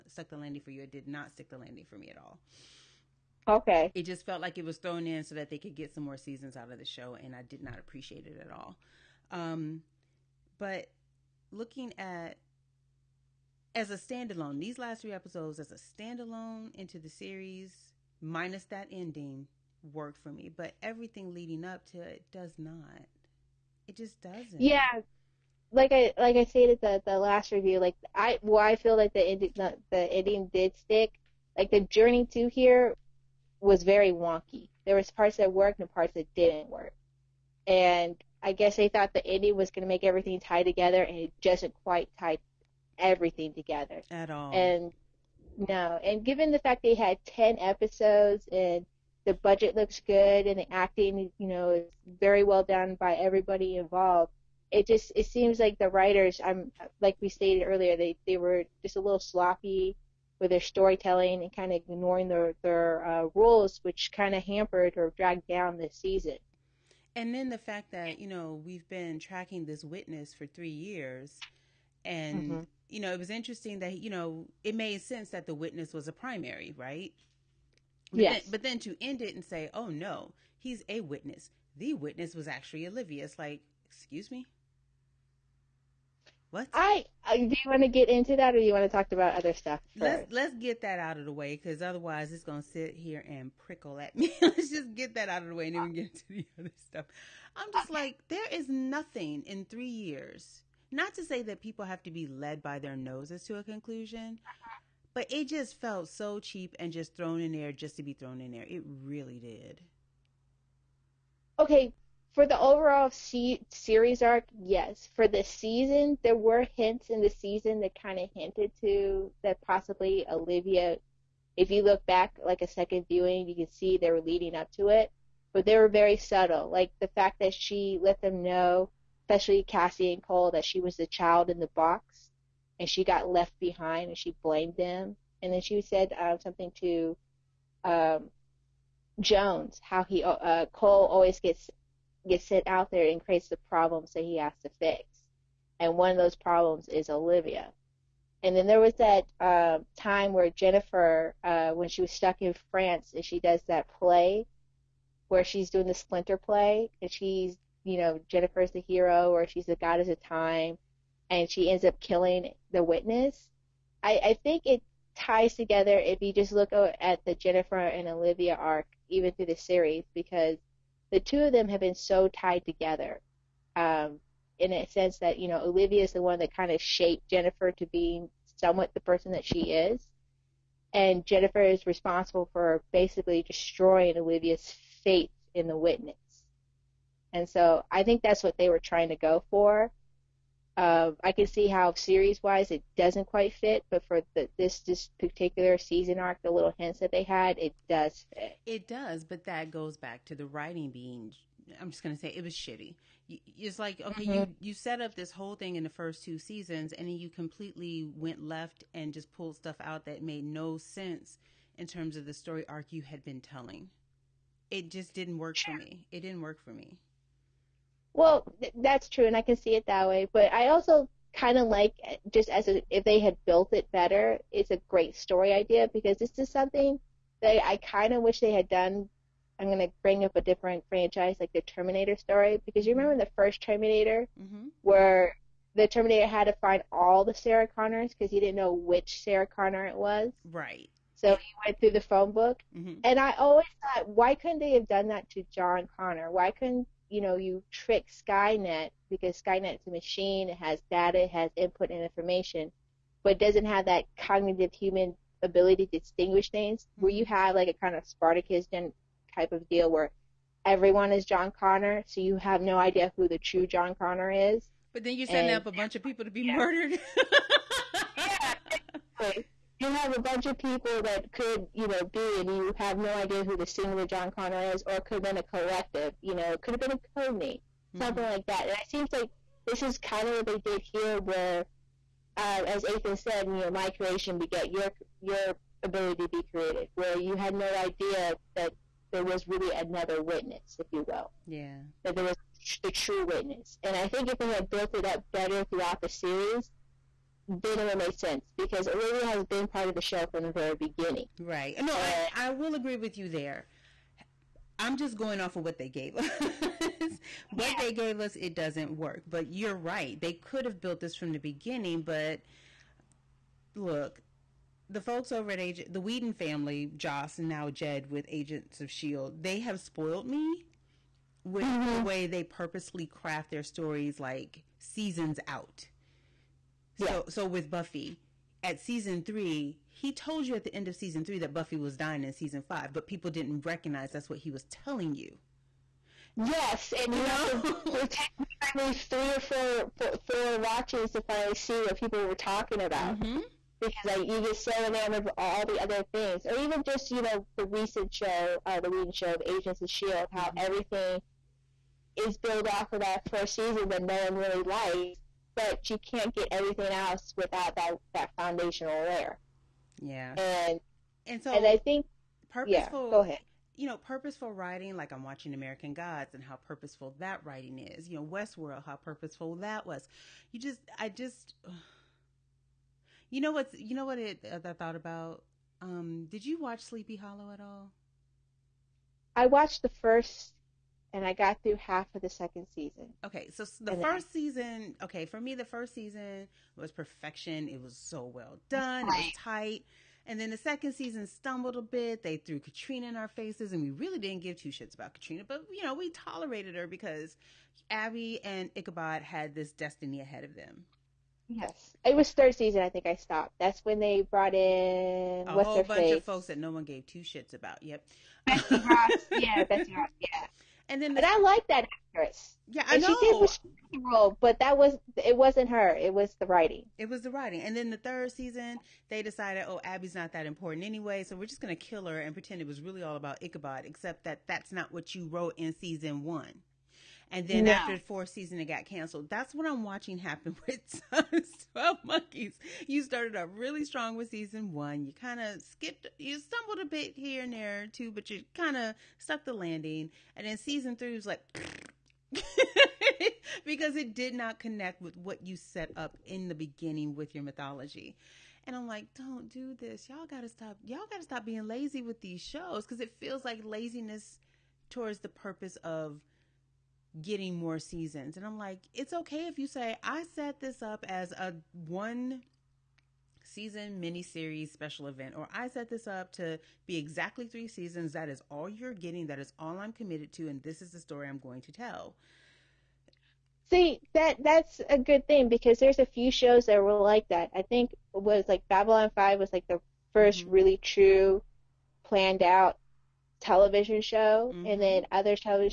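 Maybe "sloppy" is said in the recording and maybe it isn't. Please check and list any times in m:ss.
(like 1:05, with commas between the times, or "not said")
0:59.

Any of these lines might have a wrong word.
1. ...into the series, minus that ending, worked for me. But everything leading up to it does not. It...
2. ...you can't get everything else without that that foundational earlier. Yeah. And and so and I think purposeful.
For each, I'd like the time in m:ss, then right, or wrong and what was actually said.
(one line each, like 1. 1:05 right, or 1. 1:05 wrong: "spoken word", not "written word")
1. 0:16 right
2. 5:55 wrong: "layer", not "earlier".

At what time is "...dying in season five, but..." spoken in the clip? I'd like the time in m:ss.
5:31.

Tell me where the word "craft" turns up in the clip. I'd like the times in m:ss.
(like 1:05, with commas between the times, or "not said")
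5:23.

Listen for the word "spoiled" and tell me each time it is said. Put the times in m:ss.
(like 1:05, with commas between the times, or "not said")
5:19.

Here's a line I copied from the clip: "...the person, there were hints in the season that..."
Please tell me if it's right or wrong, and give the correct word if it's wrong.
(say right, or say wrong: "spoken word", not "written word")
wrong: "season", not "person".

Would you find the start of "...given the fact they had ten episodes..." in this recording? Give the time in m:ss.
0:46.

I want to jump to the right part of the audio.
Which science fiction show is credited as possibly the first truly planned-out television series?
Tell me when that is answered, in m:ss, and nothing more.
7:58.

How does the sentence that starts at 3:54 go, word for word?
where the Terminator had to find all the Sarah Connors because he didn't know which Sarah Connor it was.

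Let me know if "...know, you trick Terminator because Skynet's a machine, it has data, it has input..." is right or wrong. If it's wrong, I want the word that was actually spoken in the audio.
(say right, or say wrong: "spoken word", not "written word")
wrong: "Skynet", not "Terminator".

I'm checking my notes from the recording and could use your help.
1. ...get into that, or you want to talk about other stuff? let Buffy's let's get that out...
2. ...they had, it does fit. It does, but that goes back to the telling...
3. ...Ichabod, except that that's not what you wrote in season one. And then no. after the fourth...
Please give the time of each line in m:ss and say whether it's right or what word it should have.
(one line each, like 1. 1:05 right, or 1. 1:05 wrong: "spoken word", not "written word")
1. 1:27 wrong: "Let", not "Buffy"
2. 3:17 wrong: "writing", not "telling"
3. 7:03 right.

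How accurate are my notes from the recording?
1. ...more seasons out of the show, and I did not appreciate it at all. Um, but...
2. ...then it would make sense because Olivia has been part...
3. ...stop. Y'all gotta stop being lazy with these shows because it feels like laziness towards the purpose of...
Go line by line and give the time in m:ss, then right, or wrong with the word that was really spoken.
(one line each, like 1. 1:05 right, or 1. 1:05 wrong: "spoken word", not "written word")
1. 0:06 right
2. 4:57 right
3. 7:30 right.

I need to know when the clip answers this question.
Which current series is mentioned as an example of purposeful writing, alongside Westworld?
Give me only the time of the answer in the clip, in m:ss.
6:05.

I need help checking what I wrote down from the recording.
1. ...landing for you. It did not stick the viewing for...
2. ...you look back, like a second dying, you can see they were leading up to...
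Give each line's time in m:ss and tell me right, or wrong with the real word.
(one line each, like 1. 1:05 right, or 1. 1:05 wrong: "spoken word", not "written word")
1. 0:00 wrong: "landing", not "viewing"
2. 2:01 wrong: "viewing", not "dying".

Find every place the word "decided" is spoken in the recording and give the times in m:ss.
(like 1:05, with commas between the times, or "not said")
6:59.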